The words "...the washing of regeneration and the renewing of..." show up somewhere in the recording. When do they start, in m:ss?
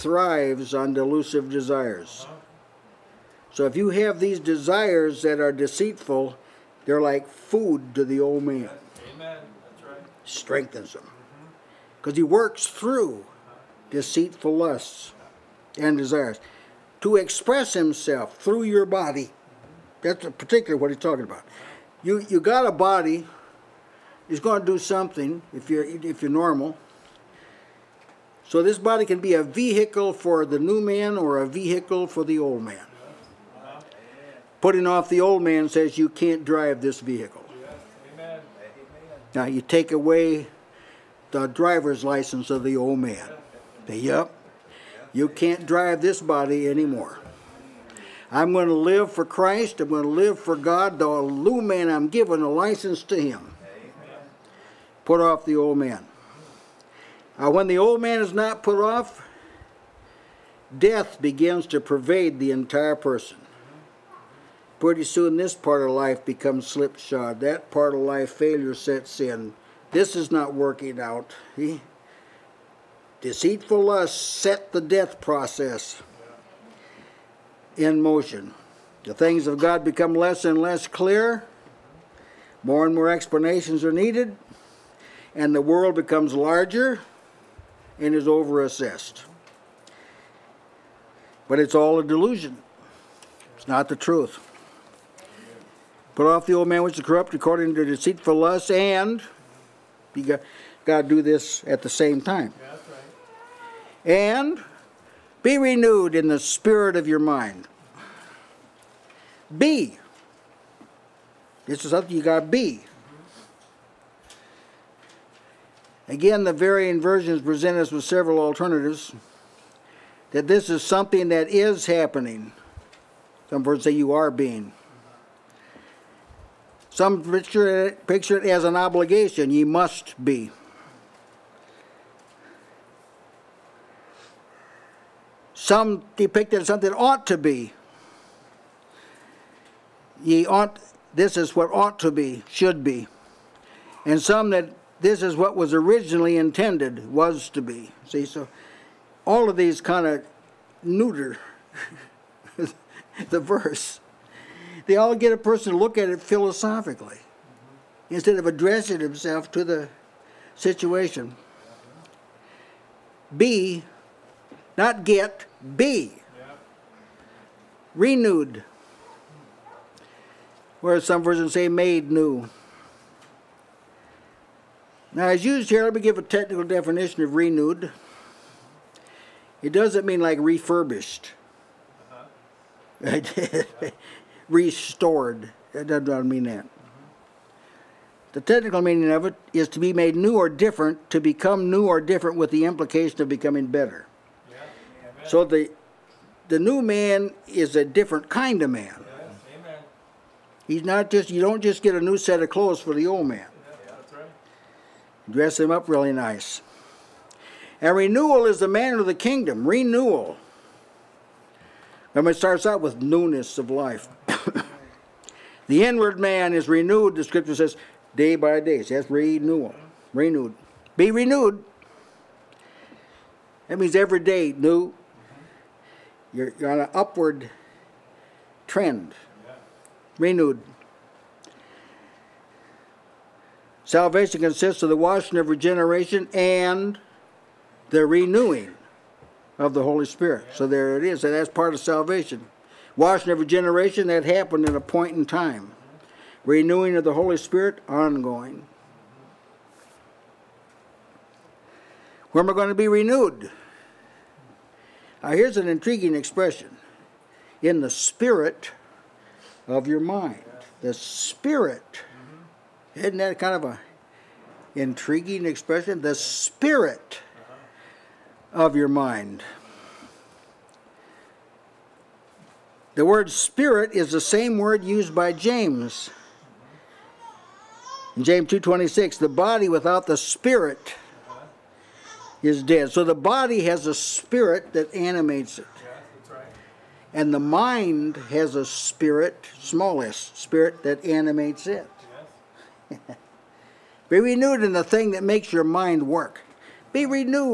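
3:54.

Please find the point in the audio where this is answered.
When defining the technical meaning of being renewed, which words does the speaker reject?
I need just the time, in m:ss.
3:00.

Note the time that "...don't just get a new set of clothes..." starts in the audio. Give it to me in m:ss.
3:21.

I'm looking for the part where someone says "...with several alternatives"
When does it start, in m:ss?
1:57.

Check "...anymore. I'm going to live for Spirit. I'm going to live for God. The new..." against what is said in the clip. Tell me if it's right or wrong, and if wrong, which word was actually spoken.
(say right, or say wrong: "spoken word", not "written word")
wrong: "Christ", not "Spirit".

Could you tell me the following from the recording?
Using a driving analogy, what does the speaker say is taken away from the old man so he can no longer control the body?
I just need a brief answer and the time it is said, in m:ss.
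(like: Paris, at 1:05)
driver's license, at 0:41.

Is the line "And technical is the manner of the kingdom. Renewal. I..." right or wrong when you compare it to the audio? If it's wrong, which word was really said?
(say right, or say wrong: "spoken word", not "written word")
wrong: "renewal", not "technical".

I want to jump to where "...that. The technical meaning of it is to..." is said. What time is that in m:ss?
3:06.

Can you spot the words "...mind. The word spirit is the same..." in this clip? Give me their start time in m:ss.
4:28.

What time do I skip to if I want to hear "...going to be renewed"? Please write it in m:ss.
4:12.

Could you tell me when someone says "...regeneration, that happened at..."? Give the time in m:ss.
4:03.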